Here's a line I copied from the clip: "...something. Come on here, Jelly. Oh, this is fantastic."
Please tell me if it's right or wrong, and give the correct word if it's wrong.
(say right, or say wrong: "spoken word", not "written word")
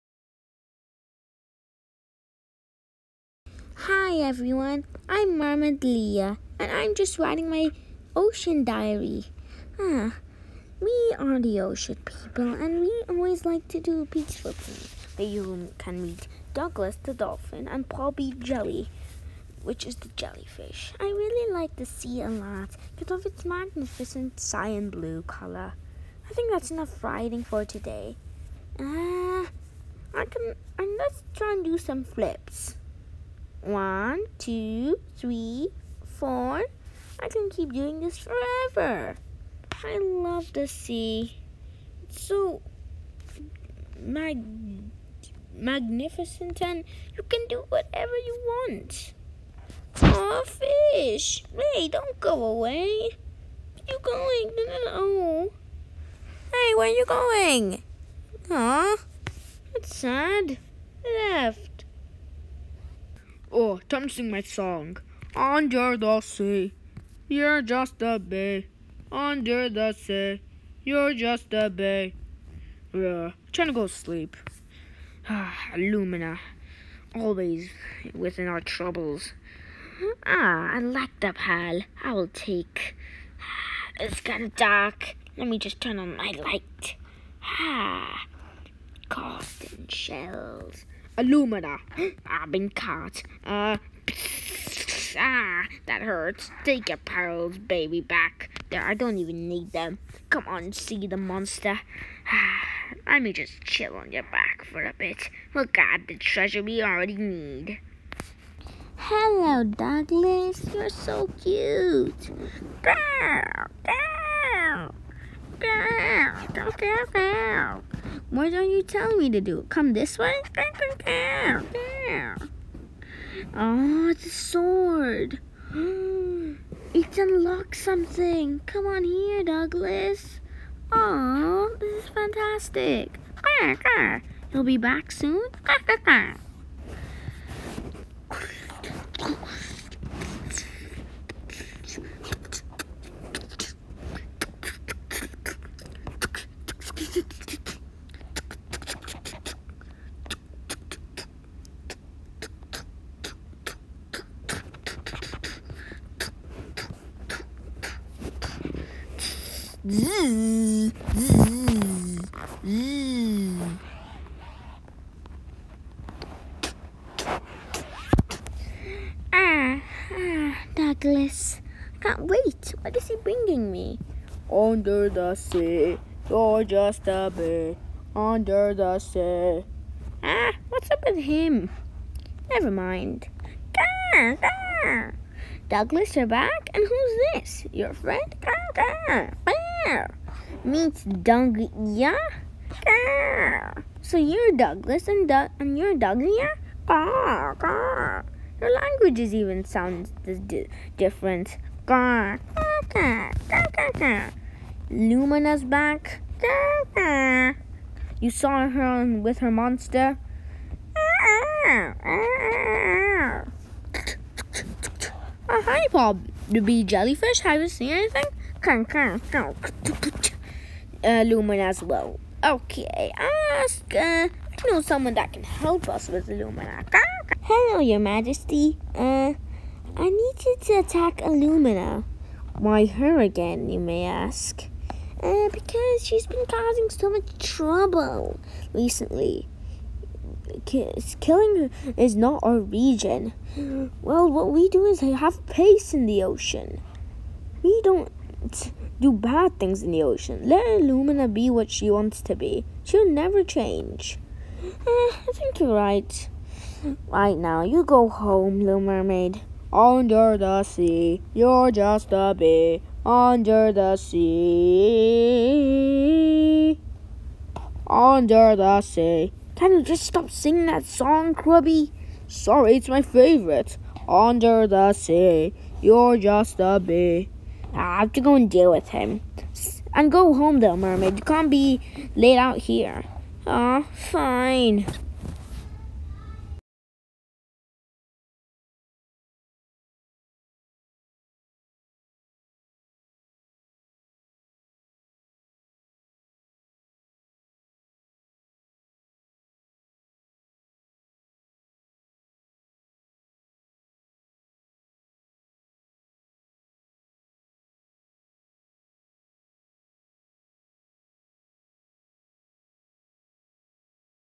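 wrong: "Douglas", not "Jelly".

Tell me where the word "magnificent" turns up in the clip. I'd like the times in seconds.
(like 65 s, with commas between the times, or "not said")
23 s, 45 s.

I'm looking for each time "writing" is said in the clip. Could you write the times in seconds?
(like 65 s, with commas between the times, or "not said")
7 s, 27 s.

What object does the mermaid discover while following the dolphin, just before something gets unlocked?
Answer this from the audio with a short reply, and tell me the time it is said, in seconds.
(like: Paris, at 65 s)
a sword, at 124 s.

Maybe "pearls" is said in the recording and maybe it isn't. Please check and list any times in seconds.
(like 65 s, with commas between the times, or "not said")
96 s.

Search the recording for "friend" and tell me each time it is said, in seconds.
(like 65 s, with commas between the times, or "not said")
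187 s.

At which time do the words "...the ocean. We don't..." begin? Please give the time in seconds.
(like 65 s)
246 s.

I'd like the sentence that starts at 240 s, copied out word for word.
Killing her is not our region.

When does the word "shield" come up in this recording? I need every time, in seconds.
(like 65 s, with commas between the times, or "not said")
not said.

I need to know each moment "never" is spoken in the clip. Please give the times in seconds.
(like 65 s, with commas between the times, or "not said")
182 s, 253 s.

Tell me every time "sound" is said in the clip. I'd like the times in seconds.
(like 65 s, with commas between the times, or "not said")
199 s.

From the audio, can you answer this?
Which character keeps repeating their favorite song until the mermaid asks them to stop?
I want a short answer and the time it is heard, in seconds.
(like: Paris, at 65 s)
Krubby, at 271 s.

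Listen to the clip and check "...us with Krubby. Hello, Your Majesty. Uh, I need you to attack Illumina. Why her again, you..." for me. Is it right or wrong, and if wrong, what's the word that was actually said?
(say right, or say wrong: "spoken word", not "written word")
wrong: "Lumina", not "Krubby".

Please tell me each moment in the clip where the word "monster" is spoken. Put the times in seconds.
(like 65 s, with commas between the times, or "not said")
101 s, 209 s.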